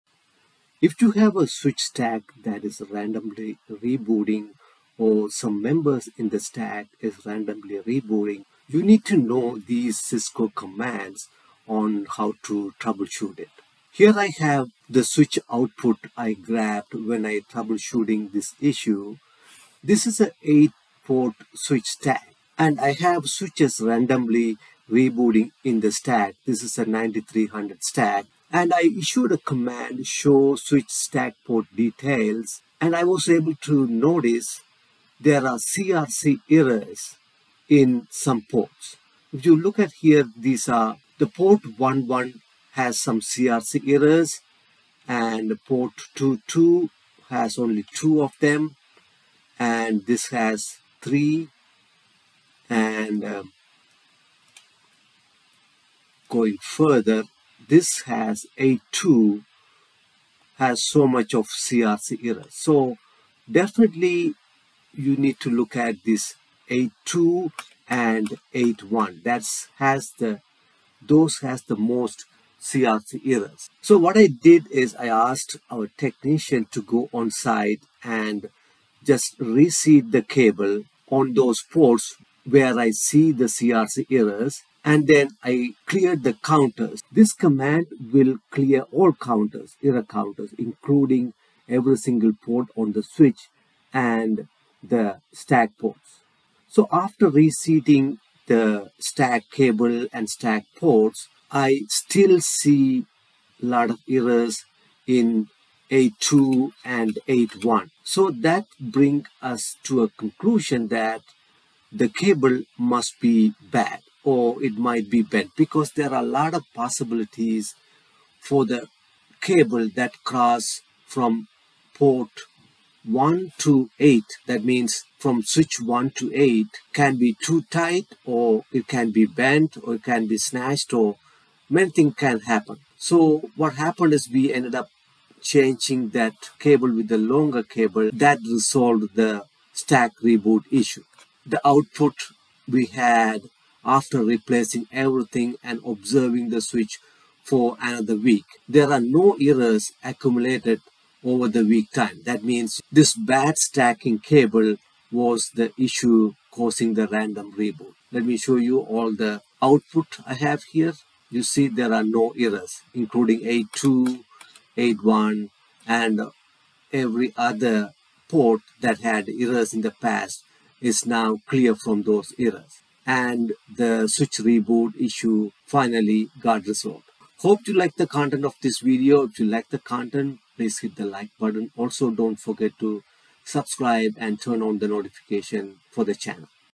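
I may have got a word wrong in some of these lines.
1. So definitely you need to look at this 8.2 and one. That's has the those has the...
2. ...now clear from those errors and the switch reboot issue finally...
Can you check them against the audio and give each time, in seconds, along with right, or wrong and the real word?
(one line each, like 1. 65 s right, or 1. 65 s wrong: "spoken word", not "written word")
1. 62 s right
2. 171 s right.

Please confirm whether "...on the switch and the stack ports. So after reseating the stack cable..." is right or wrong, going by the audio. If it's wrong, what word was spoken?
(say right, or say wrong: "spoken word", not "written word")
right.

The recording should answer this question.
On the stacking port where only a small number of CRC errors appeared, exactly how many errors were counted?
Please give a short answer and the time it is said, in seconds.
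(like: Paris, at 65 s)
2, at 47 s.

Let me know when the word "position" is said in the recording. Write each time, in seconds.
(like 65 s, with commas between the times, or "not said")
not said.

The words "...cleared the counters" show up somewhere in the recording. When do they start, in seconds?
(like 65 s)
85 s.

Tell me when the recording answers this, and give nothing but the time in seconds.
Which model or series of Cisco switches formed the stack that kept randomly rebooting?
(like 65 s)
26 s.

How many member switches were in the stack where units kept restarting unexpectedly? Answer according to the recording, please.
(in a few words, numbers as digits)
8.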